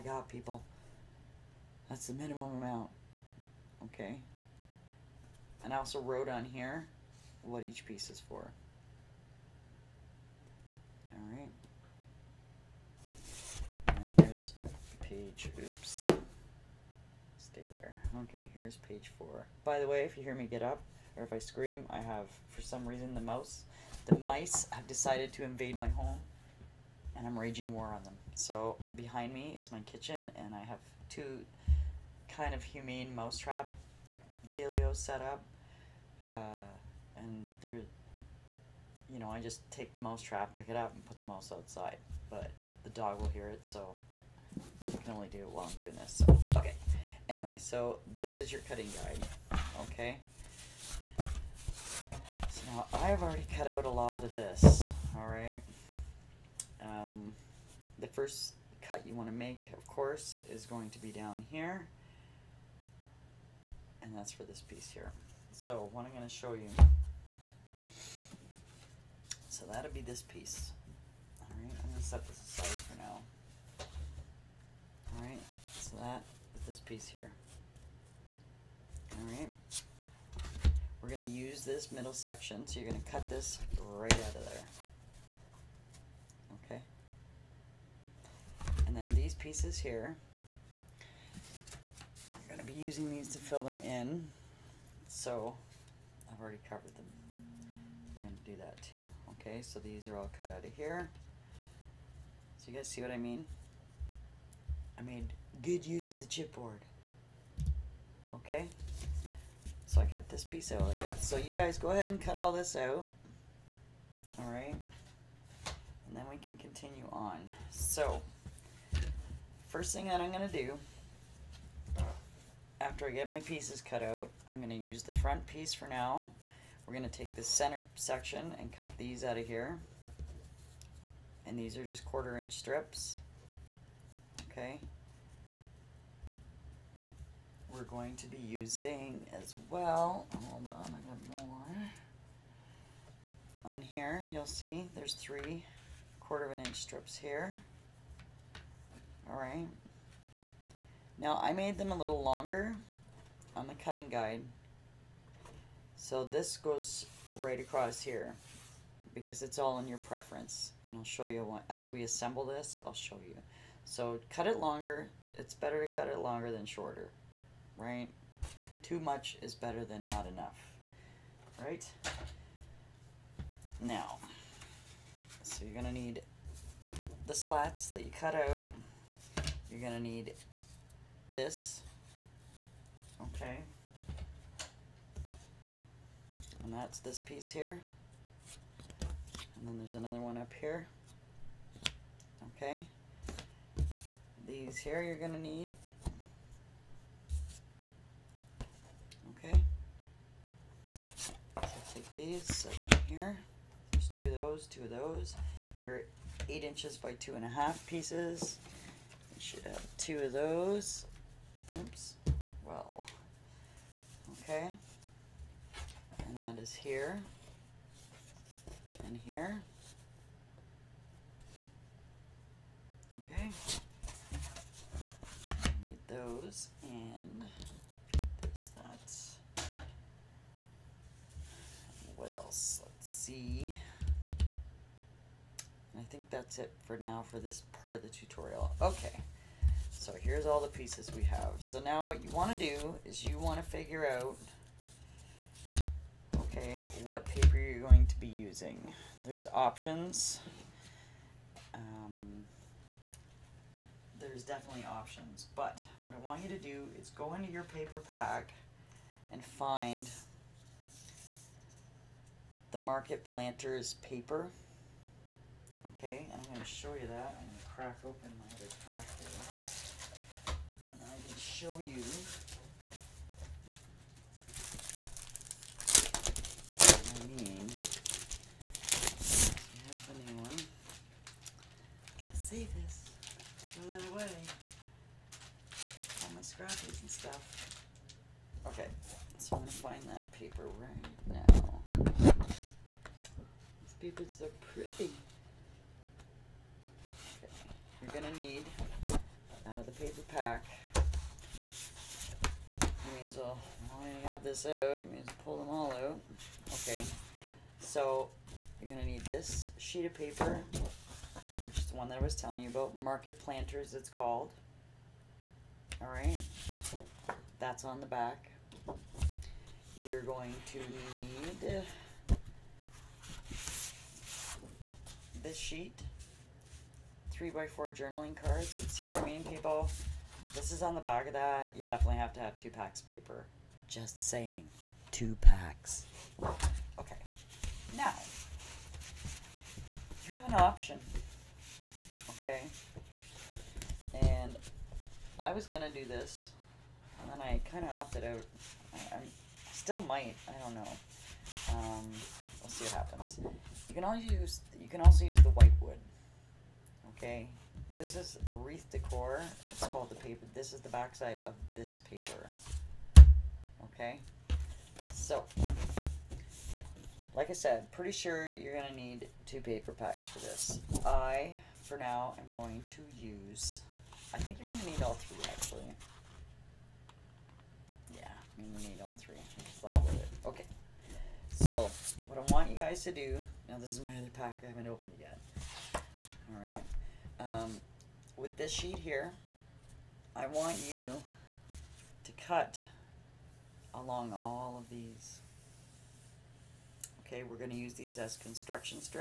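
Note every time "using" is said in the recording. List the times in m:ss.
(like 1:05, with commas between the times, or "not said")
1:32, 2:18, 4:08.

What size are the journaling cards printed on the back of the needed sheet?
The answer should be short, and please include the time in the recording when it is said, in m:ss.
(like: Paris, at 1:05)
3 by 4, at 5:27.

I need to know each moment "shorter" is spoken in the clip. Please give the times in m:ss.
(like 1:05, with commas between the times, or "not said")
2:46.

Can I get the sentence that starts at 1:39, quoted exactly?
Okay, so these are all cut out of here.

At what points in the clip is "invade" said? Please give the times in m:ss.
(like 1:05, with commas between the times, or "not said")
0:25.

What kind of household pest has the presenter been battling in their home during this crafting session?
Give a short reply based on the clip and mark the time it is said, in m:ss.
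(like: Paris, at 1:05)
mice, at 0:24.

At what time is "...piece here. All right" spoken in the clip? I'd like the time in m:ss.
1:16.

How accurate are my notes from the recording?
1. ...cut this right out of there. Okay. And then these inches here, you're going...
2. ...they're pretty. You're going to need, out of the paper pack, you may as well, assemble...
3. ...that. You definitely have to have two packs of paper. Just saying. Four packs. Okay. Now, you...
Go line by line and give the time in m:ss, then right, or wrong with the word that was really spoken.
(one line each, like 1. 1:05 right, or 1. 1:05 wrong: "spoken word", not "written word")
1. 1:23 wrong: "pieces", not "inches"
2. 4:54 wrong: "while", not "assemble"
3. 5:31 wrong: "Two", not "Four".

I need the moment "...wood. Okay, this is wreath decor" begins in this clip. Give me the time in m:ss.
5:55.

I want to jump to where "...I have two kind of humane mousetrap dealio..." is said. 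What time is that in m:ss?
0:30.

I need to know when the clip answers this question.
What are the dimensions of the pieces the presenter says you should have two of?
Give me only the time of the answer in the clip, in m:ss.
3:26.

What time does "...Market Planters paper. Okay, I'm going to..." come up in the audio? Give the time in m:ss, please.
4:22.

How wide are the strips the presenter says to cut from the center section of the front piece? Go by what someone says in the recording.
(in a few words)
quarter inch.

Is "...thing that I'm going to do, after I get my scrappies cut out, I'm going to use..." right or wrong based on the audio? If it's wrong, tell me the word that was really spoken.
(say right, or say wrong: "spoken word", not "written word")
wrong: "pieces", not "scrappies".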